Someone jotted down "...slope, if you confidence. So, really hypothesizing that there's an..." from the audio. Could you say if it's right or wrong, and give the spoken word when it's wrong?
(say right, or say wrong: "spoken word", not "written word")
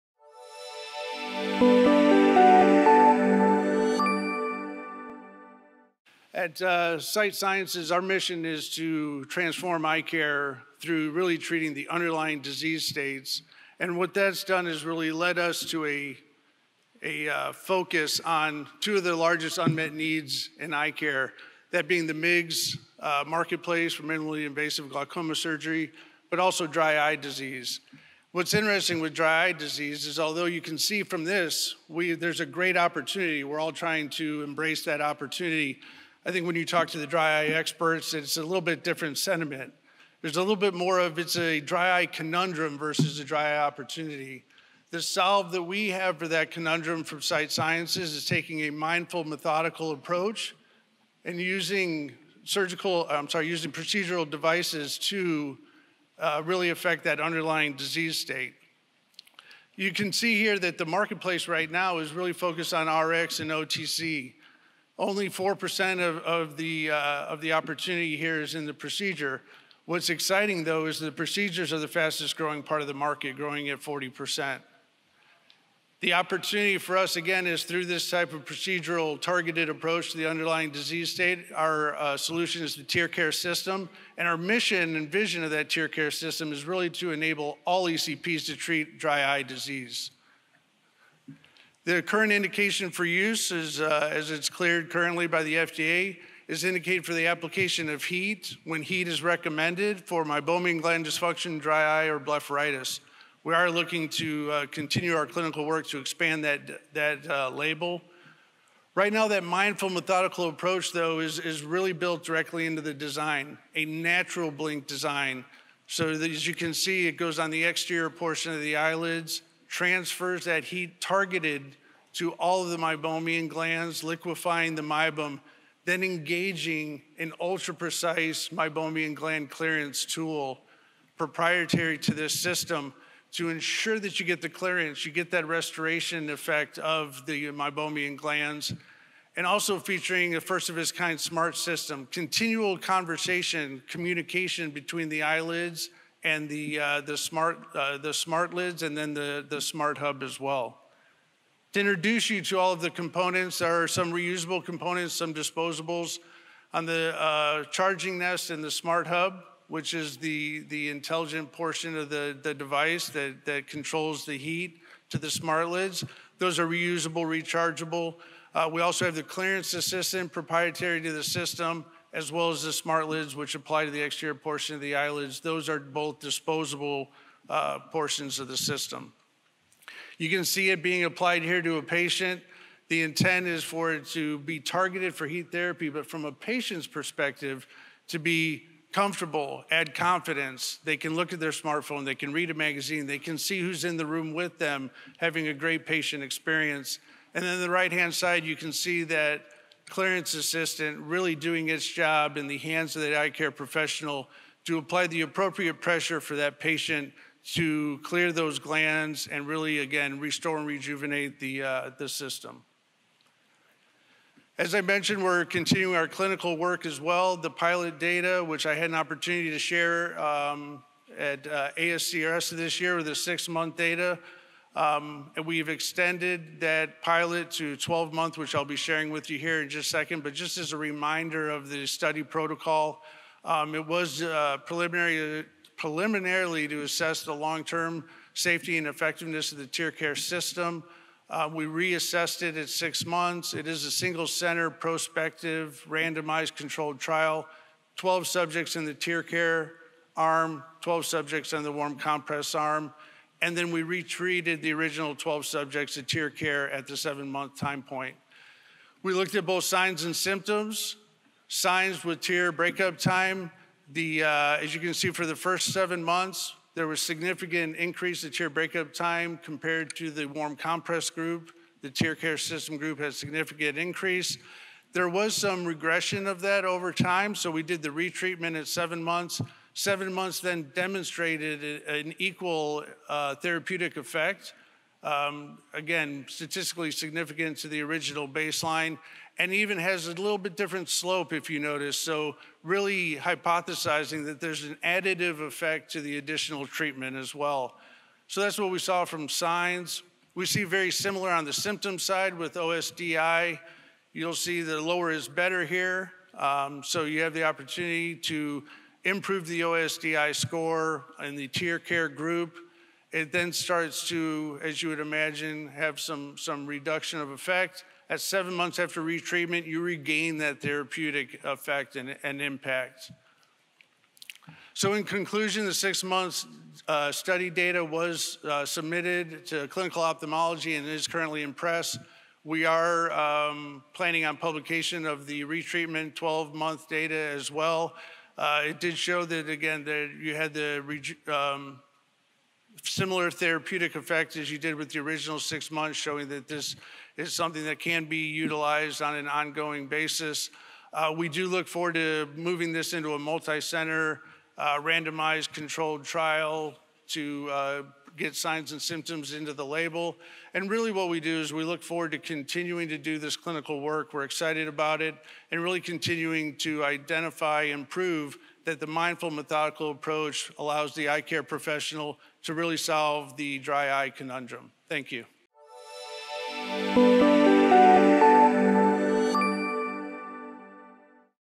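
wrong: "notice", not "confidence".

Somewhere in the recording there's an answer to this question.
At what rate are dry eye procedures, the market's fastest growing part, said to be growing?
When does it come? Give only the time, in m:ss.
1:13.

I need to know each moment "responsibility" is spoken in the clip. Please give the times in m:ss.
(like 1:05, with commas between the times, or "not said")
not said.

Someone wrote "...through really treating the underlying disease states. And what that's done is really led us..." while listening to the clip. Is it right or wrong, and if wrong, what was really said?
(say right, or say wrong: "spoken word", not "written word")
right.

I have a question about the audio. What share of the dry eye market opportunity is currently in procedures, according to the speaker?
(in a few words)
4%.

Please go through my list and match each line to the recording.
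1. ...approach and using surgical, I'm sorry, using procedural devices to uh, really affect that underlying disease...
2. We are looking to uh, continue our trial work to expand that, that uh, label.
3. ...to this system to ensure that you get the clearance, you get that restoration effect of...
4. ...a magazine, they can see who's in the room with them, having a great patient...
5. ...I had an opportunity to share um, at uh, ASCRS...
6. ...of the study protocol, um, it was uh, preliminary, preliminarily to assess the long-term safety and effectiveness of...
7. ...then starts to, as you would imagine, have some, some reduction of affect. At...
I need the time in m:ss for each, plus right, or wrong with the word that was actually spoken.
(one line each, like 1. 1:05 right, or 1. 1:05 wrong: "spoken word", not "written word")
1. 0:49 right
2. 1:43 wrong: "clinical", not "trial"
3. 2:11 right
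4. 3:12 right
5. 3:38 right
6. 3:51 right
7. 5:13 wrong: "effect", not "affect".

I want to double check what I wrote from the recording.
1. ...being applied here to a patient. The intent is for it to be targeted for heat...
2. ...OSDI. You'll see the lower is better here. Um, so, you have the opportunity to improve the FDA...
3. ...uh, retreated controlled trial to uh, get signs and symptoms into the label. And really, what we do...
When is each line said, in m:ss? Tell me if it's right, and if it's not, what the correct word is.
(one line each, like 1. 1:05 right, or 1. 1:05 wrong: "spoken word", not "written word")
1. 3:00 right
2. 5:02 wrong: "OSDI", not "FDA"
3. 5:54 wrong: "randomized", not "retreated".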